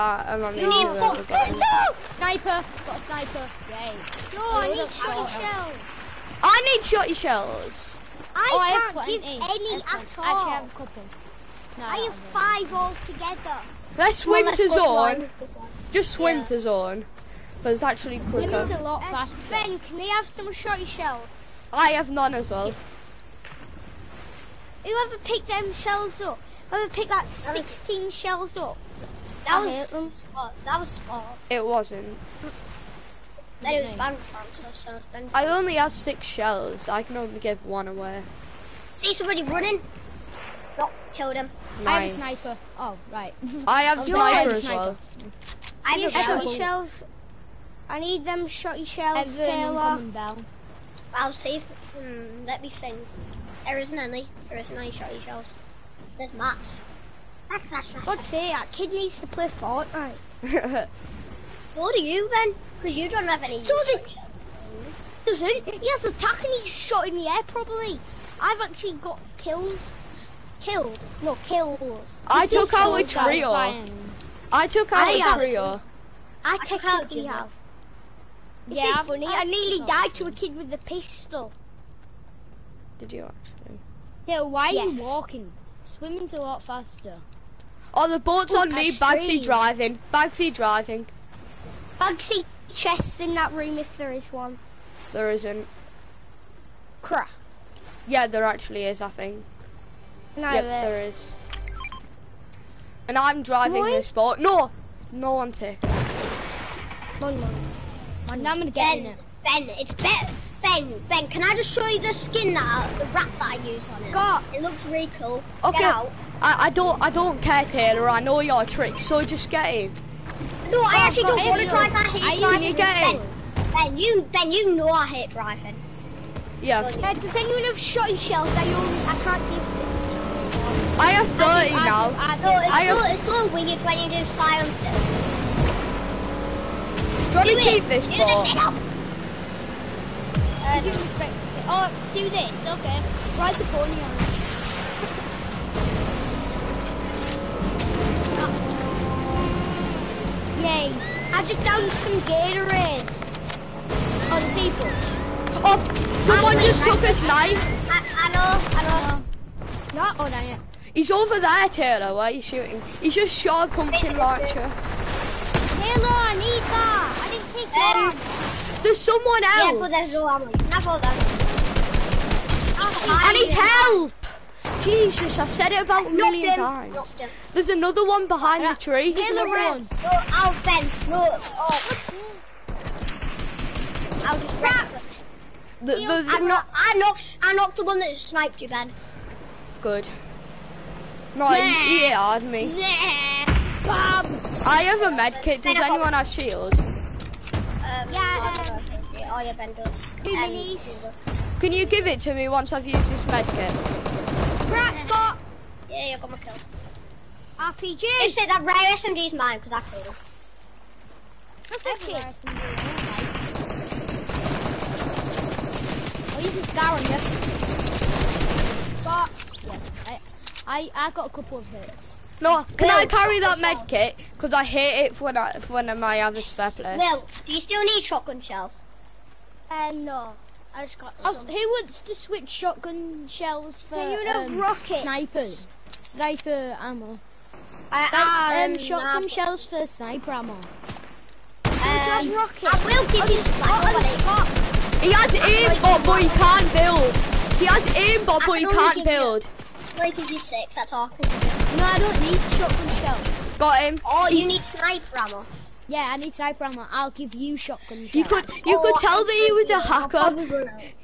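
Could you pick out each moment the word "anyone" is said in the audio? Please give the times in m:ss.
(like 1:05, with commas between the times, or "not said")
2:07, 3:15.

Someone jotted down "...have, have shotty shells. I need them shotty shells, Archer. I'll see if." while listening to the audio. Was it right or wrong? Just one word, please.
wrong.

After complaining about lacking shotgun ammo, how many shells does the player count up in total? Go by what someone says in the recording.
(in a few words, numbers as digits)
5.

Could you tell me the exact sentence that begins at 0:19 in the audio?
Sven, can they have some shotty shells?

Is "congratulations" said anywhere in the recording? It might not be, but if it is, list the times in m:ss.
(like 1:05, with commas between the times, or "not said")
not said.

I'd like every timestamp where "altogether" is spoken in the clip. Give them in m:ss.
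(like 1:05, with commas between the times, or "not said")
0:12.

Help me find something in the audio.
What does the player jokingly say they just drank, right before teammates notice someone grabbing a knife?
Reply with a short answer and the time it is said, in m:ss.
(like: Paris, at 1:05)
Gatorade, at 2:32.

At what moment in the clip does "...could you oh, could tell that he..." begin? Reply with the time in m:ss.
4:18.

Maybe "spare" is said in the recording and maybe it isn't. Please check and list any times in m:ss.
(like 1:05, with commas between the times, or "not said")
3:46.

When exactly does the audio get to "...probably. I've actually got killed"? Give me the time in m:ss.
1:07.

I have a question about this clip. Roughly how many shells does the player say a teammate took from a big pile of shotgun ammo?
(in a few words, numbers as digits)
16.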